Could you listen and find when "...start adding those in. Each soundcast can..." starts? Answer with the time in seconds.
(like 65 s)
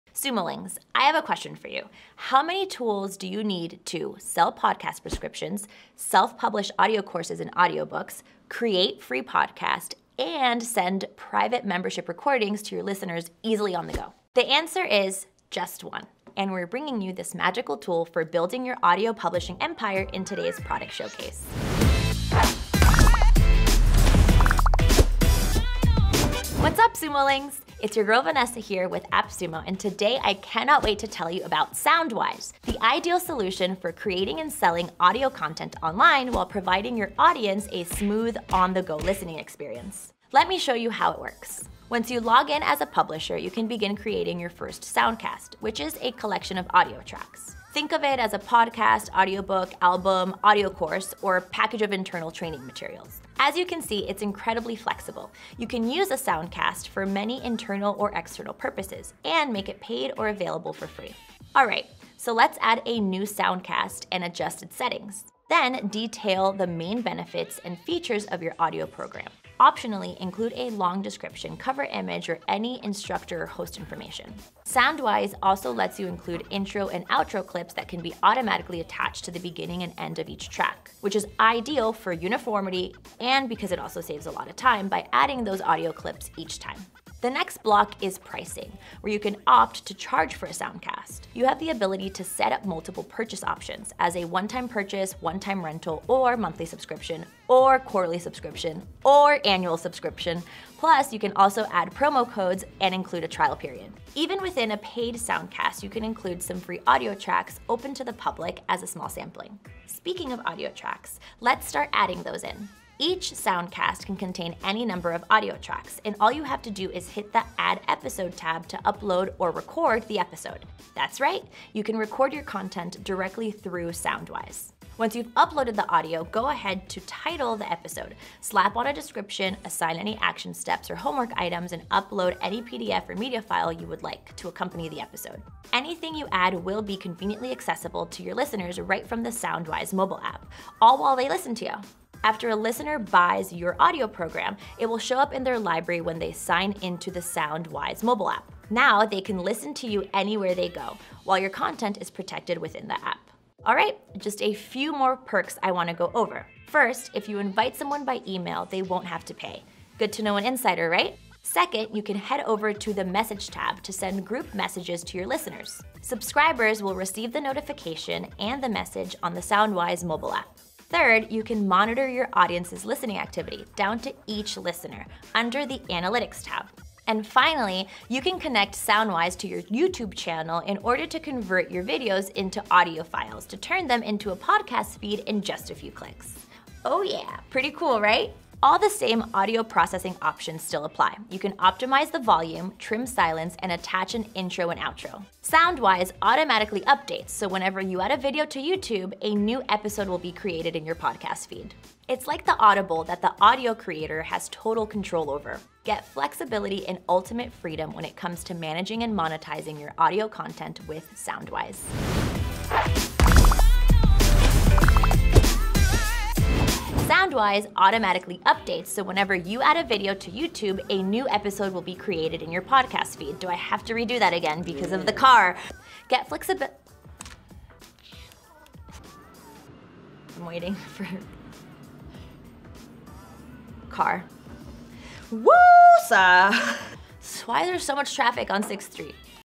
111 s.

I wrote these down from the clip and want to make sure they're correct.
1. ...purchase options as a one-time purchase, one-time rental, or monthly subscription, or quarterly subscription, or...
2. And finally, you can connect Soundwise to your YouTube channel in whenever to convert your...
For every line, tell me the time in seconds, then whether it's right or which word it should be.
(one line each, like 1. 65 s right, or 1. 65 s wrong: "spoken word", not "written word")
1. 93 s right
2. 177 s wrong: "order", not "whenever".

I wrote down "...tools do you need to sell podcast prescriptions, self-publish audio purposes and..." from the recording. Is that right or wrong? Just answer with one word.
wrong.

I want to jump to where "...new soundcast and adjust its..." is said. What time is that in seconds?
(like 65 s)
62 s.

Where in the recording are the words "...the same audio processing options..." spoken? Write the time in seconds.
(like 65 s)
188 s.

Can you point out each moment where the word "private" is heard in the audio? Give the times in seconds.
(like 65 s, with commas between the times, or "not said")
11 s.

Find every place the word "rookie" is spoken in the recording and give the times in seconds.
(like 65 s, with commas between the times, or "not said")
not said.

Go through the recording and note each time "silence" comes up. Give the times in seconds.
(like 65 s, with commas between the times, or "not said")
193 s.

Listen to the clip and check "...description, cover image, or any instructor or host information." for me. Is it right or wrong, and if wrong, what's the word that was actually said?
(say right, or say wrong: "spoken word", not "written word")
right.